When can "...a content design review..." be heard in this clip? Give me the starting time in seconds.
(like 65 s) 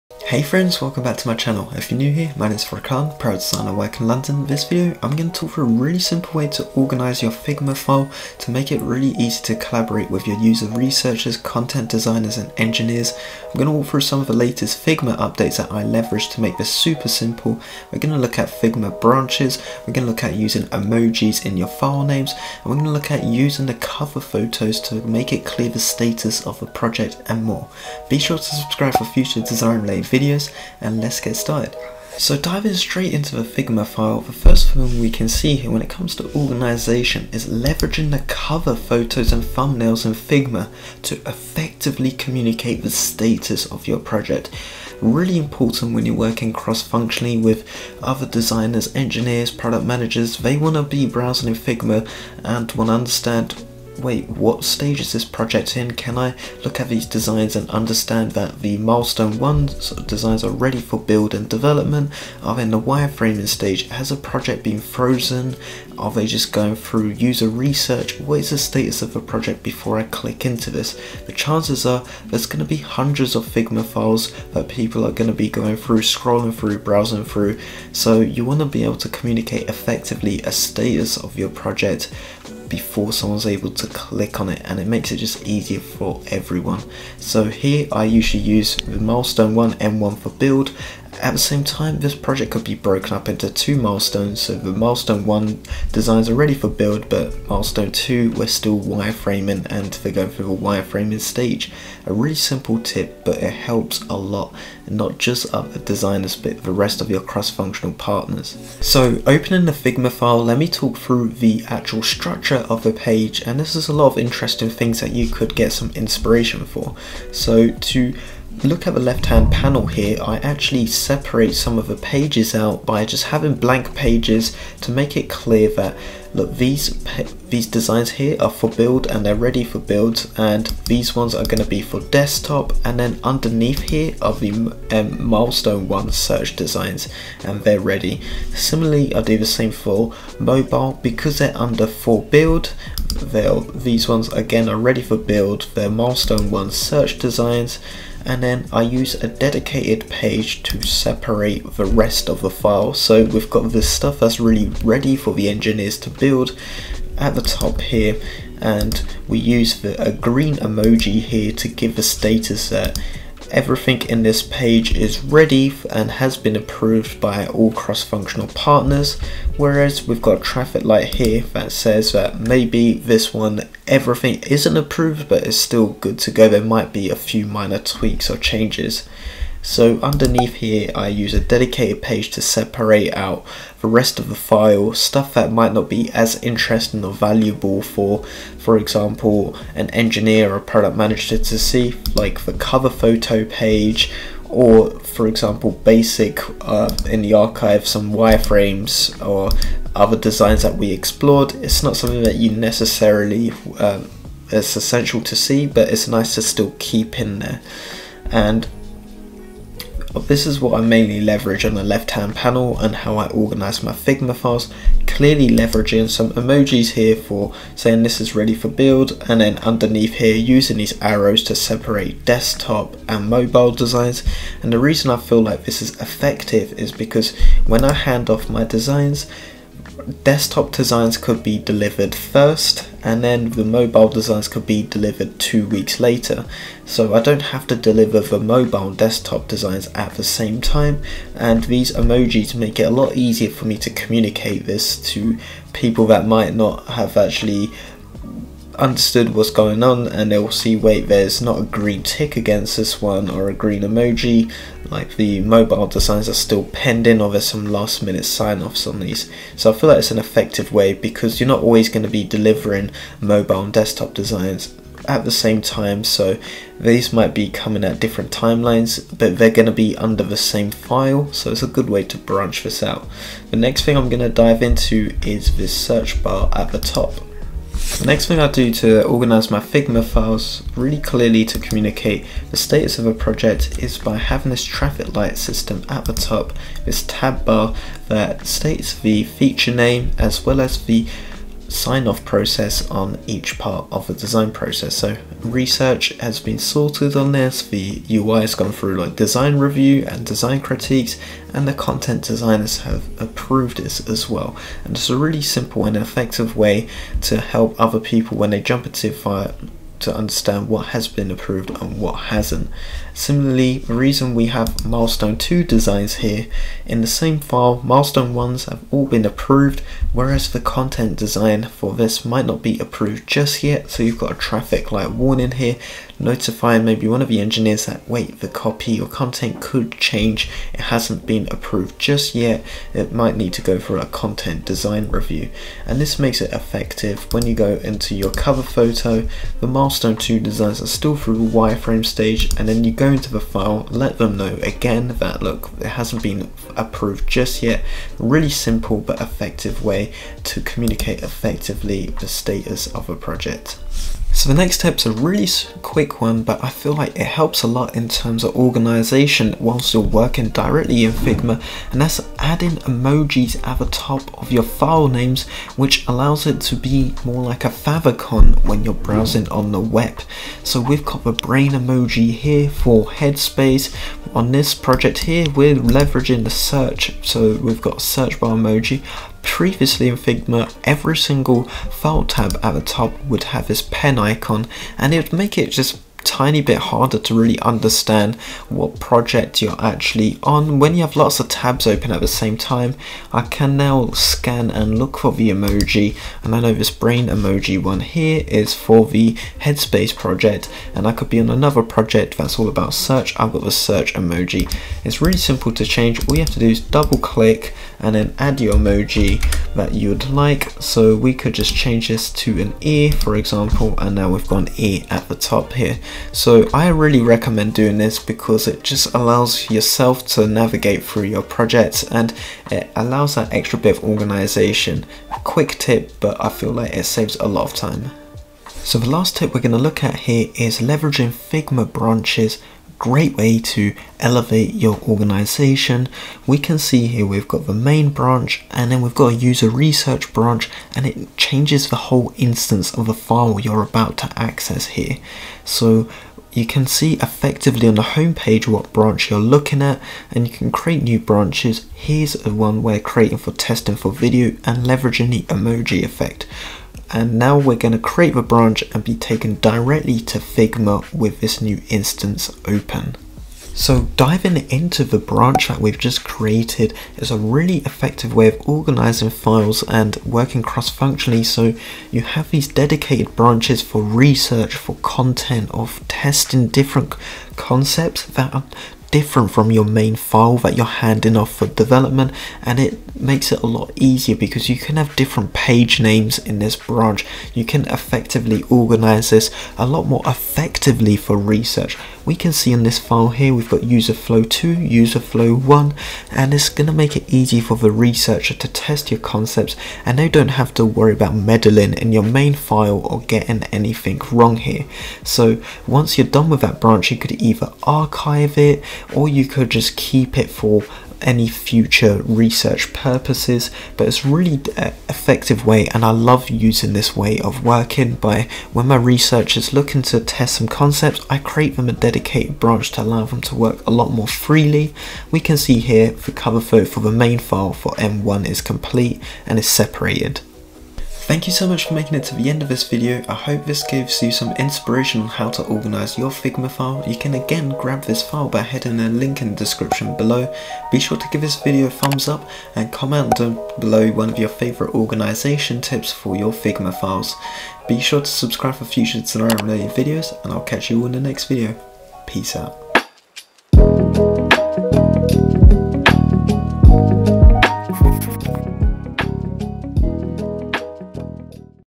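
333 s.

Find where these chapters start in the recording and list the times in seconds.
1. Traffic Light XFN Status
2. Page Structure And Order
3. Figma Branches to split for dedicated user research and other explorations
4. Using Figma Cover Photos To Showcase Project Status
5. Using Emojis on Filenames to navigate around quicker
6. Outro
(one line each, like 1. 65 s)
1. 278 s
2. 110 s
3. 429 s
4. 33 s
5. 360 s
6. 530 s.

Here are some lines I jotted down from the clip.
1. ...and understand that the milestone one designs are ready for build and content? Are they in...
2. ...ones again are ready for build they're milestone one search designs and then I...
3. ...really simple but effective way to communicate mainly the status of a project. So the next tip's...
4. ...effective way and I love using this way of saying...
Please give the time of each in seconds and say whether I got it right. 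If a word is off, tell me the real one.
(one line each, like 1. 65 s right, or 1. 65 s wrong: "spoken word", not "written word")
1. 57 s wrong: "development", not "content"
2. 144 s right
3. 348 s wrong: "effectively", not "mainly"
4. 515 s wrong: "working", not "saying".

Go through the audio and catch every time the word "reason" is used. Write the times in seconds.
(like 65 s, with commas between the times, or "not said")
224 s, 313 s.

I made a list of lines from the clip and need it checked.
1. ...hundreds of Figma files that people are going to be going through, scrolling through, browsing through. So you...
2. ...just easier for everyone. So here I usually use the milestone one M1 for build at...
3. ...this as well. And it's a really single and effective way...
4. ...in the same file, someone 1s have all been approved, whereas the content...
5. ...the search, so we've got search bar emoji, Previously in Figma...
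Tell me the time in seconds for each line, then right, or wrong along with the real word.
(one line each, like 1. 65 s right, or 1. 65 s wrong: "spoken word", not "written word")
1. 72 s right
2. 85 s right
3. 303 s wrong: "simple", not "single"
4. 316 s wrong: "milestone", not "someone"
5. 376 s right.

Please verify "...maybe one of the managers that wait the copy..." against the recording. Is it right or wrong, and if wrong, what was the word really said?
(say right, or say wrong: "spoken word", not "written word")
wrong: "engineers", not "managers".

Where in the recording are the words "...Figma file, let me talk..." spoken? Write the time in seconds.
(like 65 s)
109 s.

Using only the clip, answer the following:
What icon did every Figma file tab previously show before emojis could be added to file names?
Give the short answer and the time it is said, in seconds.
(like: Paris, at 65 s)
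Pen icon, at 383 s.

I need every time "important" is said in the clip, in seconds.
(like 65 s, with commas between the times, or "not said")
45 s.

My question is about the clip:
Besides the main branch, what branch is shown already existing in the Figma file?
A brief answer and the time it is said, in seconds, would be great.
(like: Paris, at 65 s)
User research branch, at 439 s.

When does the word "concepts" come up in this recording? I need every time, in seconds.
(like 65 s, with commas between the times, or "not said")
477 s, 499 s, 520 s.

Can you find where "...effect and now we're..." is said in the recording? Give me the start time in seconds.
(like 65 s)
456 s.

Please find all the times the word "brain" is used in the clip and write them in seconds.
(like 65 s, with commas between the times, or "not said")
371 s, 396 s.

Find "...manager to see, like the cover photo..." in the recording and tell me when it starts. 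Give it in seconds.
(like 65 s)
190 s.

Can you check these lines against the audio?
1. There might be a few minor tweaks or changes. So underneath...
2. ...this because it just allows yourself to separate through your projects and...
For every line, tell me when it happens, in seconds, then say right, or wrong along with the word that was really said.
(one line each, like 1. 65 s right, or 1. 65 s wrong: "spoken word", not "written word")
1. 176 s right
2. 417 s wrong: "navigate", not "separate".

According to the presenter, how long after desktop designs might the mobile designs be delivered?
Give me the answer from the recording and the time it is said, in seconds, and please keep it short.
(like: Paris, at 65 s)
Two weeks later, at 235 s.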